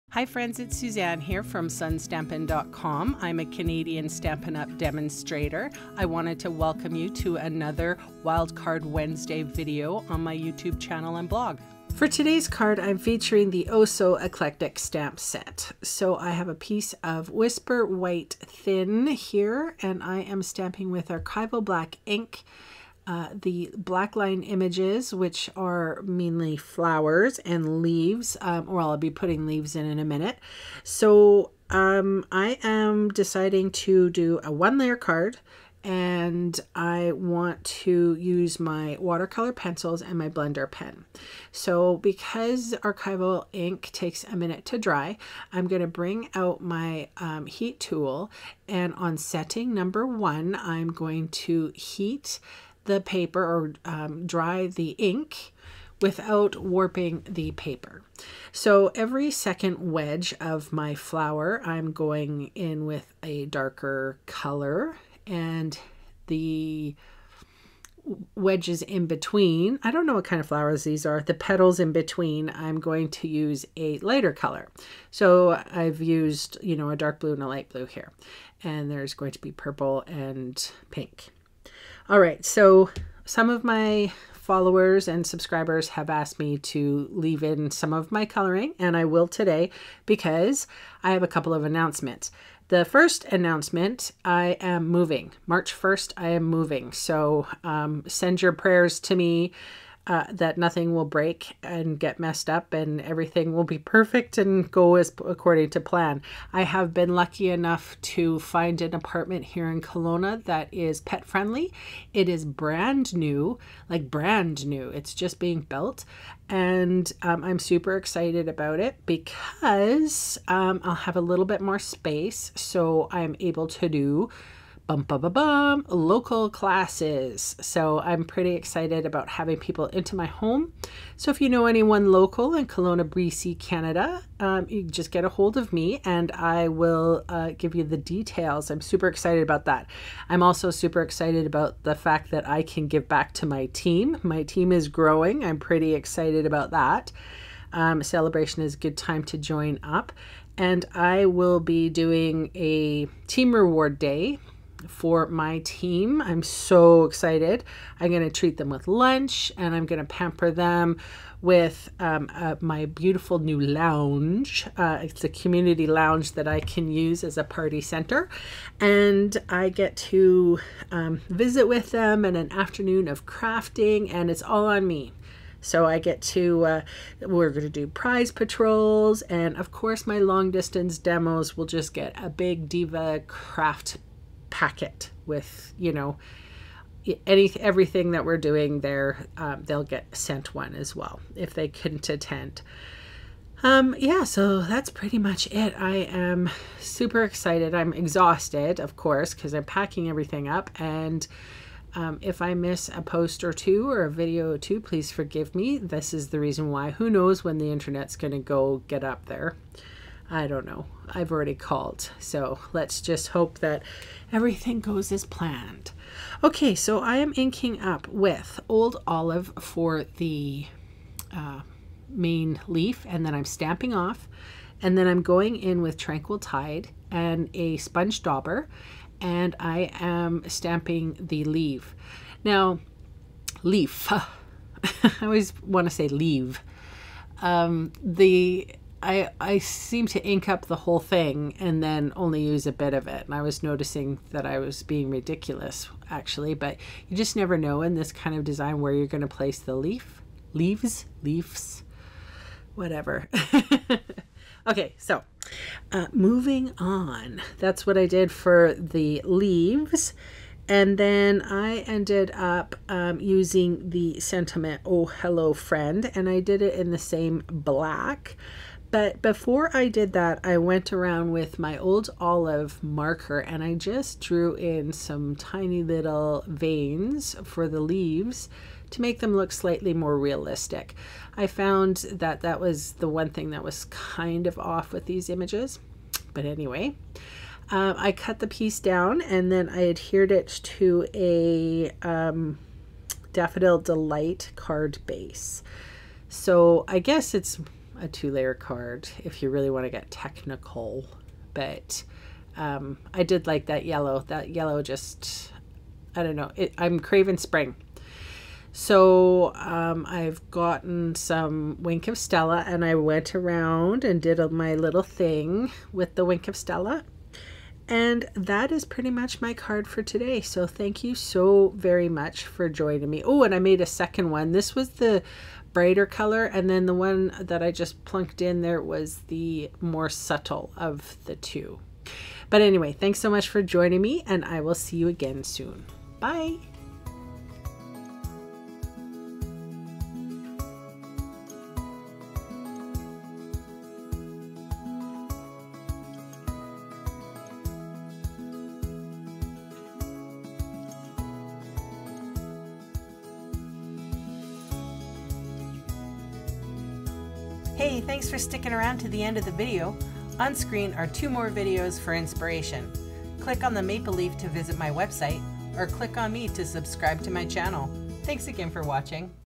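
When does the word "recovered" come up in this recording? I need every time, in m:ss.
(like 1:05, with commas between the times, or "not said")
not said.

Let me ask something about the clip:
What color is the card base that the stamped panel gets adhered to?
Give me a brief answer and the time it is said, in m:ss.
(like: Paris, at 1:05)
Daffodil Delight, at 4:53.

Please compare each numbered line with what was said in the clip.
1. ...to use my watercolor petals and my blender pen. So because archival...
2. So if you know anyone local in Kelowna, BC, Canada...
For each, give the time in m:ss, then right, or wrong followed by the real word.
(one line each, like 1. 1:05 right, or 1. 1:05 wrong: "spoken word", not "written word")
1. 0:37 wrong: "pencils", not "petals"
2. 2:11 right.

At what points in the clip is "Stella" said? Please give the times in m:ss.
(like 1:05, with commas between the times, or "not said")
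5:12, 5:16.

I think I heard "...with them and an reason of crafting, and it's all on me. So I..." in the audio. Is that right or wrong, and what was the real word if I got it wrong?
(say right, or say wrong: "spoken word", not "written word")
wrong: "afternoon", not "reason".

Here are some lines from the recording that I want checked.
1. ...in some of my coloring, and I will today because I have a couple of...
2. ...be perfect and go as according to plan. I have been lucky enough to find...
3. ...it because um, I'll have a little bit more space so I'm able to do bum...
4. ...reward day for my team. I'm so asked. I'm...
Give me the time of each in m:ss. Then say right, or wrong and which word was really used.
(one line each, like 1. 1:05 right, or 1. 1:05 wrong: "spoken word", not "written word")
1. 1:27 right
2. 1:43 right
3. 1:58 right
4. 2:33 wrong: "excited", not "asked".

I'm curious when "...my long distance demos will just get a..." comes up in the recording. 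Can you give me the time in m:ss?
3:00.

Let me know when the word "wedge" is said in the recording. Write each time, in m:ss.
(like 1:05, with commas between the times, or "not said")
0:59, 1:08.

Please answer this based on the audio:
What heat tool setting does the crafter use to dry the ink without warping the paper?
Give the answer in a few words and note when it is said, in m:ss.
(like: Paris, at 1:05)
1, at 0:49.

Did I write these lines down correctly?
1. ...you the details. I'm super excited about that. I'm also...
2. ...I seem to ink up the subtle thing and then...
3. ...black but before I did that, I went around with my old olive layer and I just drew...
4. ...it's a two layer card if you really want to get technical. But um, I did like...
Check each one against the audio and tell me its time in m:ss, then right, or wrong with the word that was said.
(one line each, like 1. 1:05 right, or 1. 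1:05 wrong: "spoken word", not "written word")
1. 2:17 right
2. 3:59 wrong: "whole", not "subtle"
3. 4:27 wrong: "marker", not "layer"
4. 4:57 right.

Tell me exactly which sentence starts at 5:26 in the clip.
And then the one that I just plunked in there was the more subtle of the two.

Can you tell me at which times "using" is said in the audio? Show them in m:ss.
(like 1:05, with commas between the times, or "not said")
4:23.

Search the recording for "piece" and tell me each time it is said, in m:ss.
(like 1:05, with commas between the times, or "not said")
0:16, 4:48.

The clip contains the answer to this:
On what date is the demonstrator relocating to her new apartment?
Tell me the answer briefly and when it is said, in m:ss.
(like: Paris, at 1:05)
March 1st, at 1:35.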